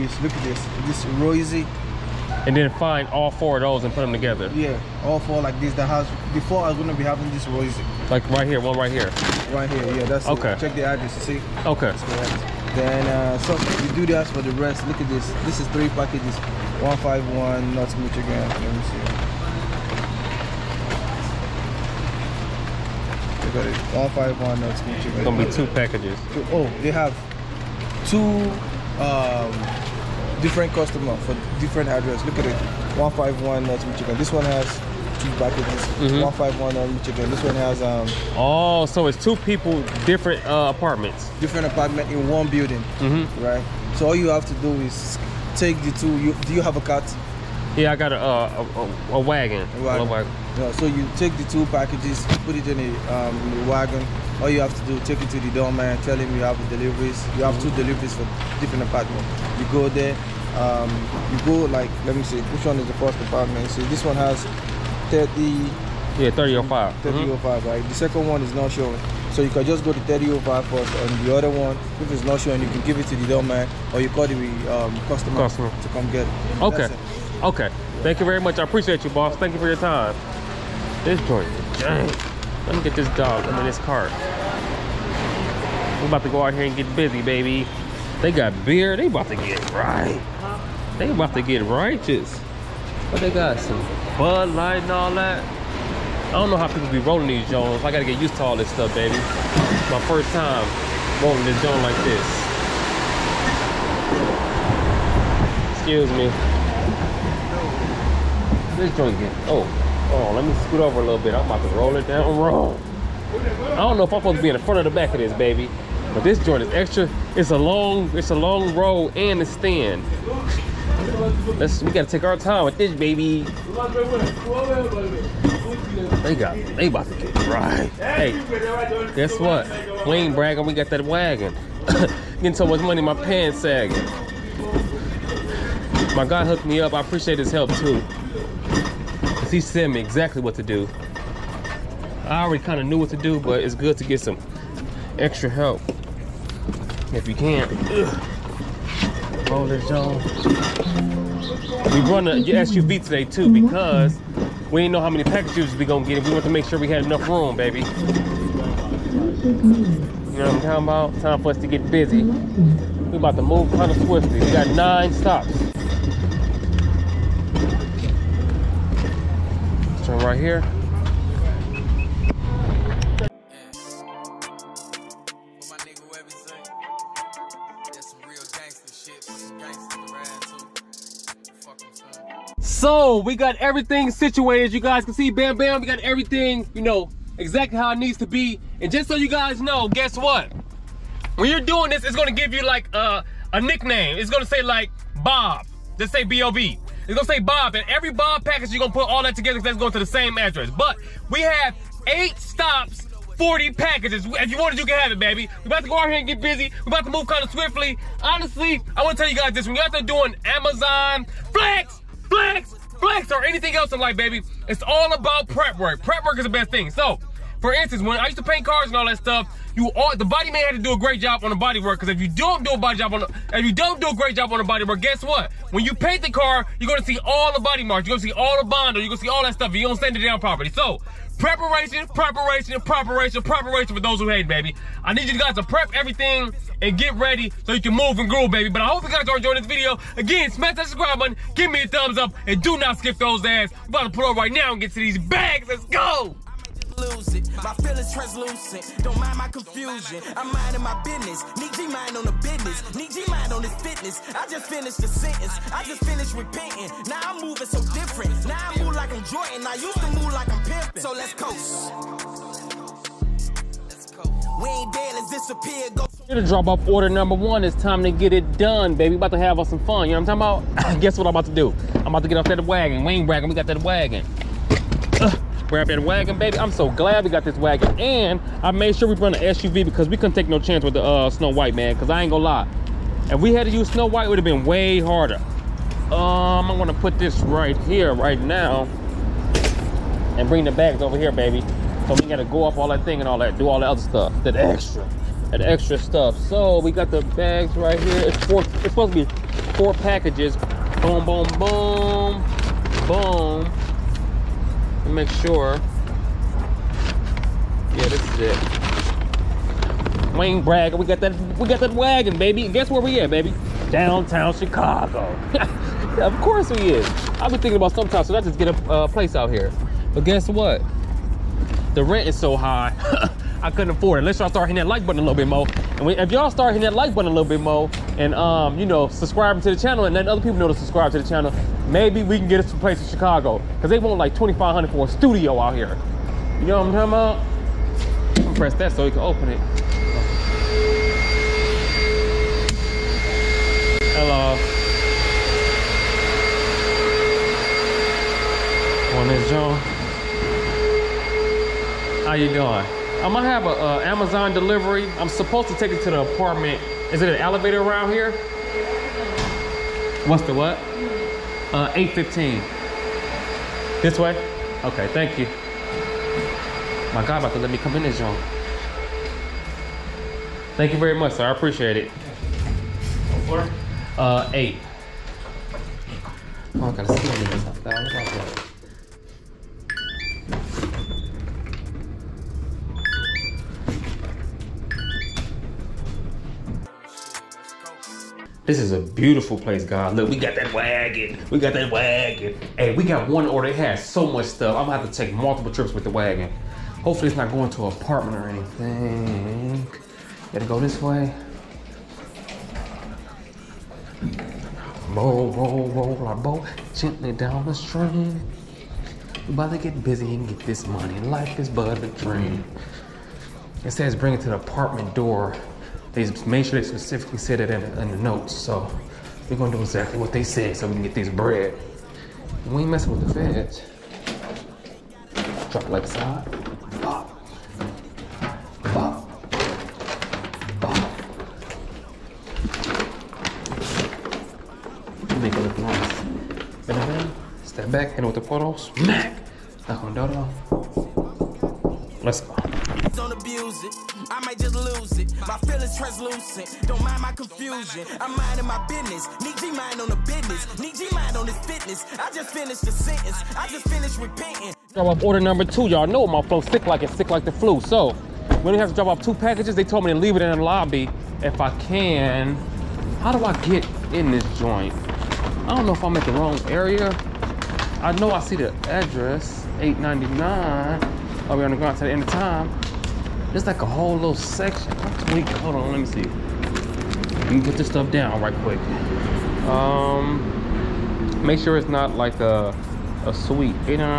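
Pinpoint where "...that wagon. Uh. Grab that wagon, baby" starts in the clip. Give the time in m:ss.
4:33.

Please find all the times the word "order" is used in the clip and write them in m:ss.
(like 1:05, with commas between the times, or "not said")
4:26, 6:33, 7:35.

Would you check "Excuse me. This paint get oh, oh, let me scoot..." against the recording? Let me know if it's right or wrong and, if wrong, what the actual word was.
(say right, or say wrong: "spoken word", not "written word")
wrong: "joint", not "paint".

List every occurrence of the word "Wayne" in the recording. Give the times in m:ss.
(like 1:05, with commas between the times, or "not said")
5:10.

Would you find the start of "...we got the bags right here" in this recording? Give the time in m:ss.
4:56.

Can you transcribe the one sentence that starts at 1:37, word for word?
I gotta get used to all this stuff, baby.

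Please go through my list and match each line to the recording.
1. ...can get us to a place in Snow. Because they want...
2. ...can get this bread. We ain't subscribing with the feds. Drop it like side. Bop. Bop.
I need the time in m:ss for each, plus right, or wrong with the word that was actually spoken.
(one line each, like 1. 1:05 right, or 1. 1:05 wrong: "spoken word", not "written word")
1. 5:32 wrong: "Chicago", not "Snow"
2. 7:00 wrong: "messing", not "subscribing".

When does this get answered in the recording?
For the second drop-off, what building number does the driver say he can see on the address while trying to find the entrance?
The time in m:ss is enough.
7:49.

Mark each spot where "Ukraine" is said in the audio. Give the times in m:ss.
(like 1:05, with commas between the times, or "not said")
not said.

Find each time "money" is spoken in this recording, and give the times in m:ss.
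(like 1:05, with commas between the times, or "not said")
2:12, 6:50.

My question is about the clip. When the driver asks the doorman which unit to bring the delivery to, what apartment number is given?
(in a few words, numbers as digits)
815.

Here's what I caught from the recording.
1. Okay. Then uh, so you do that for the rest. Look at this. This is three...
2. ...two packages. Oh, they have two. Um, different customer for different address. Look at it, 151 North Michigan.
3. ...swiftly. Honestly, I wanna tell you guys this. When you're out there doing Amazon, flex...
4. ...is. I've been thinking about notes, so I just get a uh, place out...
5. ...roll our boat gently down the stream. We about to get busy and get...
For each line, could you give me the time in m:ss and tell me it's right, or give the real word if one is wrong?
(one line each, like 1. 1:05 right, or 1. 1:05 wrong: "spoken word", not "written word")
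1. 0:11 right
2. 0:25 right
3. 3:27 right
4. 5:16 wrong: "sometimes", not "notes"
5. 6:45 right.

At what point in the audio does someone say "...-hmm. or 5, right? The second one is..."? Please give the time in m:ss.
1:07.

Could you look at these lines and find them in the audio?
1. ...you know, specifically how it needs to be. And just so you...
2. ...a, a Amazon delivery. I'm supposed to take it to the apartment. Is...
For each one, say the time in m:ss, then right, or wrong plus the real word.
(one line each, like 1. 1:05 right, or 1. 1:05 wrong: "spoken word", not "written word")
1. 3:06 wrong: "exactly", not "specifically"
2. 5:53 right.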